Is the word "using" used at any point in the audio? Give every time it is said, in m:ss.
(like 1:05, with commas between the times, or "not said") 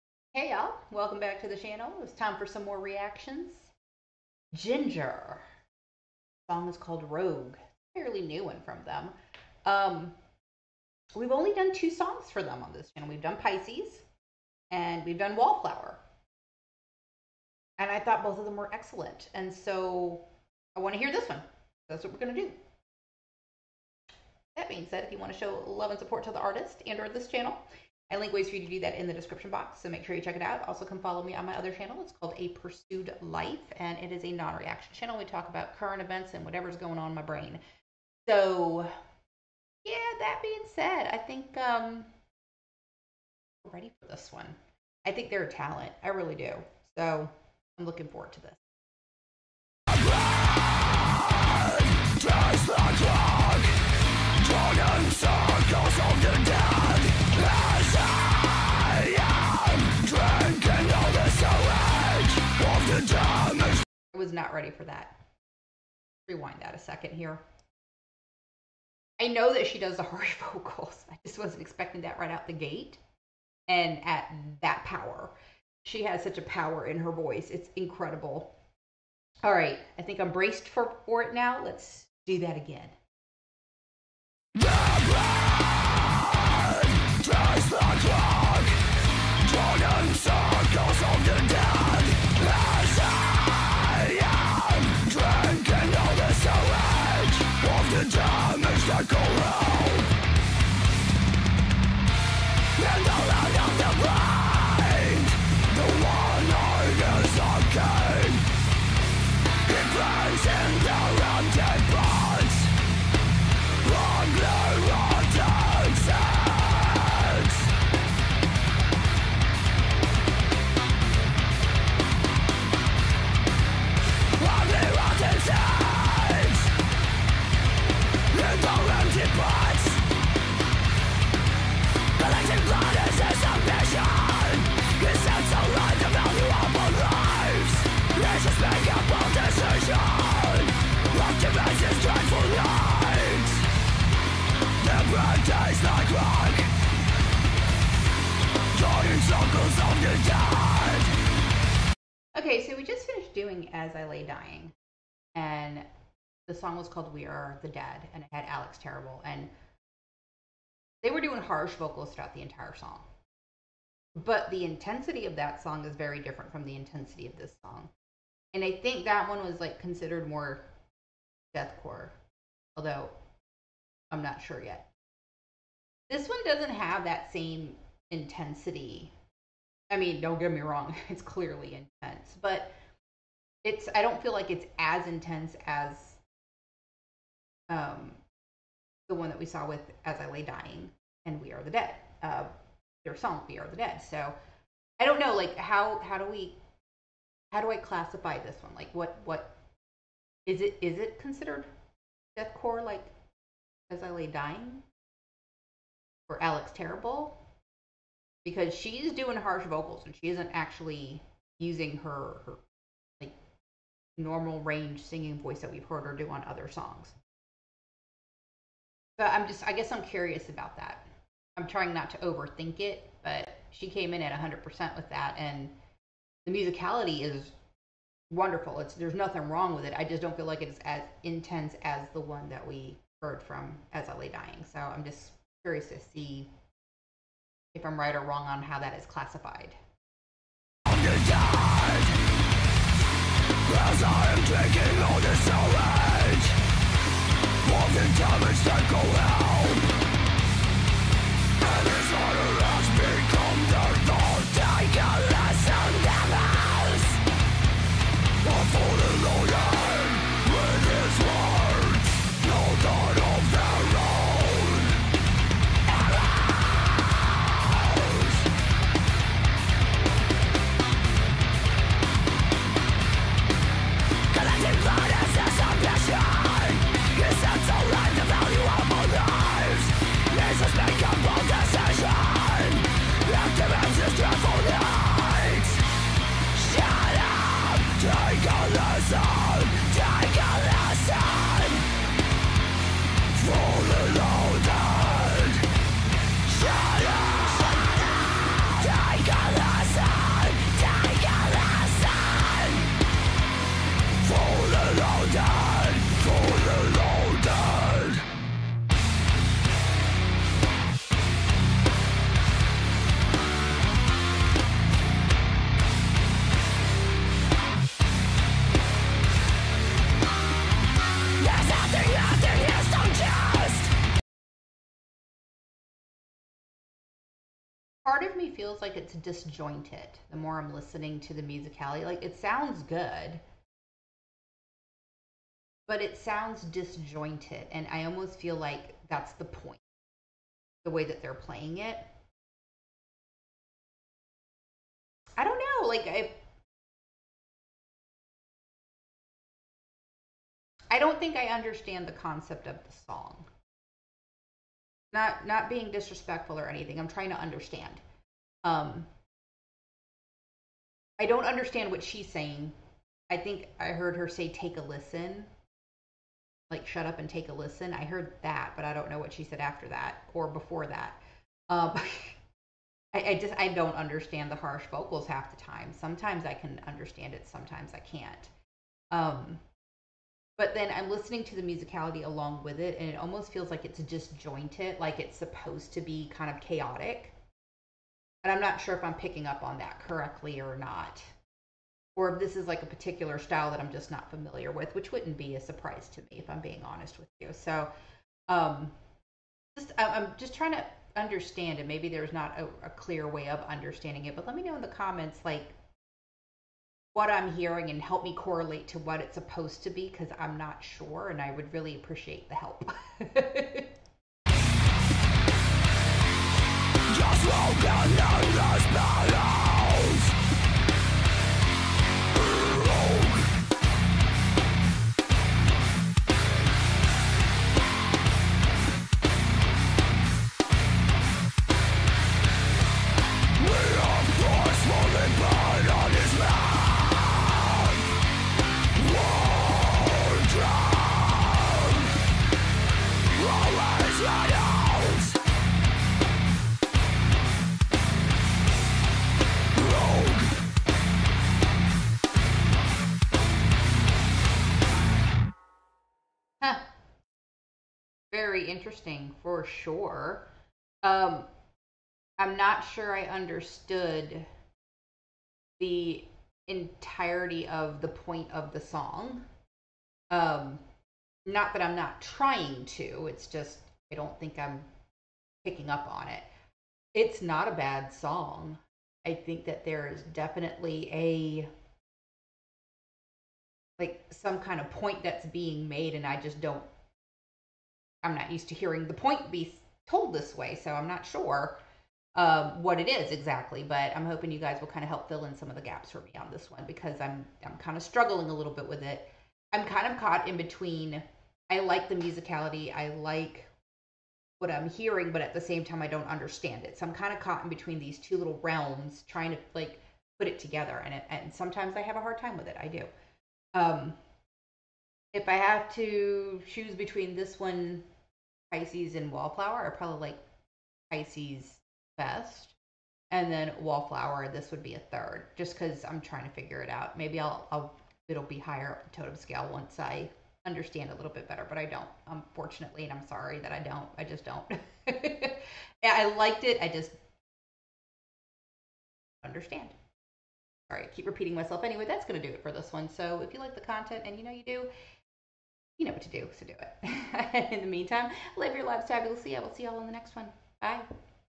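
3:31.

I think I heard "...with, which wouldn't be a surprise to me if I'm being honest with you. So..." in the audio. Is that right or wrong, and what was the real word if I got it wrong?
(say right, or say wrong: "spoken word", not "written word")
right.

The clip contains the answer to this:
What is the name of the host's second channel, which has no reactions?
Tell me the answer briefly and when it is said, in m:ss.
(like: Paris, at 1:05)
A Pursued Life, at 0:32.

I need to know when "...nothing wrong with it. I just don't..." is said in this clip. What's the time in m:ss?
3:49.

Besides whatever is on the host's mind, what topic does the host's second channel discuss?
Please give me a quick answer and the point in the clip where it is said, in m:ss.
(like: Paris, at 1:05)
Current events, at 0:35.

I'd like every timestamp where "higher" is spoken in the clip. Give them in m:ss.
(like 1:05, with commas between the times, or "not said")
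8:48.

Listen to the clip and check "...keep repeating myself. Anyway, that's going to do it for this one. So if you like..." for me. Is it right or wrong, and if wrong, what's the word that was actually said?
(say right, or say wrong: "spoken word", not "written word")
right.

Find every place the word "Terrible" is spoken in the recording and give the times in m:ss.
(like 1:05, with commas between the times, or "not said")
2:38, 3:26.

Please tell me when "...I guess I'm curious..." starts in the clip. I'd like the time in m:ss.
3:39.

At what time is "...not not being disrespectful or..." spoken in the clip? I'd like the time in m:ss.
5:55.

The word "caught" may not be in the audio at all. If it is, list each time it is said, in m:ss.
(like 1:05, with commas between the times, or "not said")
8:20, 8:27.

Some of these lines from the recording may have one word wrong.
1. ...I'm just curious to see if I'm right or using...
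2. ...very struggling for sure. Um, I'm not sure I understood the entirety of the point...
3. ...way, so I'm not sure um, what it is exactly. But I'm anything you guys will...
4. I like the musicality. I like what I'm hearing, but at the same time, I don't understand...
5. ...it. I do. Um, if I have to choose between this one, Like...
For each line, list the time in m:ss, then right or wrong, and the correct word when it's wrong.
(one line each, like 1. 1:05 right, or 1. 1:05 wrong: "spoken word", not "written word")
1. 3:54 wrong: "wrong", not "using"
2. 7:38 wrong: "interesting", not "struggling"
3. 8:10 wrong: "hoping", not "anything"
4. 8:21 right
5. 8:32 wrong: "Pisces", not "Like".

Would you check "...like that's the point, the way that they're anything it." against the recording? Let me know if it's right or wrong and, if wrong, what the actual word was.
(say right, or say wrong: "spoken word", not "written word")
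wrong: "playing", not "anything".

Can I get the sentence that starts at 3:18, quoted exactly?
Like what what is it is it considered deathcore like As I Lay Dying?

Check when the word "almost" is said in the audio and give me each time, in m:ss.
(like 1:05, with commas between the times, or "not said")
5:38, 6:23.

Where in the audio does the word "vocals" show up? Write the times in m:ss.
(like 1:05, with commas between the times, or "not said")
1:10, 2:41, 3:29, 6:14.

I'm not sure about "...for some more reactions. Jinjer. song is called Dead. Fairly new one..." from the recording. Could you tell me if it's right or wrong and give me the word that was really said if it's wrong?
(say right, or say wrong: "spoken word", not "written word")
wrong: "Rogue", not "Dead".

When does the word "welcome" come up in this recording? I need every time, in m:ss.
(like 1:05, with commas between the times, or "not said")
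0:00.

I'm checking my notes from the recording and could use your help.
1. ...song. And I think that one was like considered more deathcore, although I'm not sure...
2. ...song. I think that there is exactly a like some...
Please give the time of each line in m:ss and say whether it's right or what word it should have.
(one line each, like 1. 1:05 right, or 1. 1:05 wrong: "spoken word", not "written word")
1. 2:47 right
2. 7:58 wrong: "definitely", not "exactly".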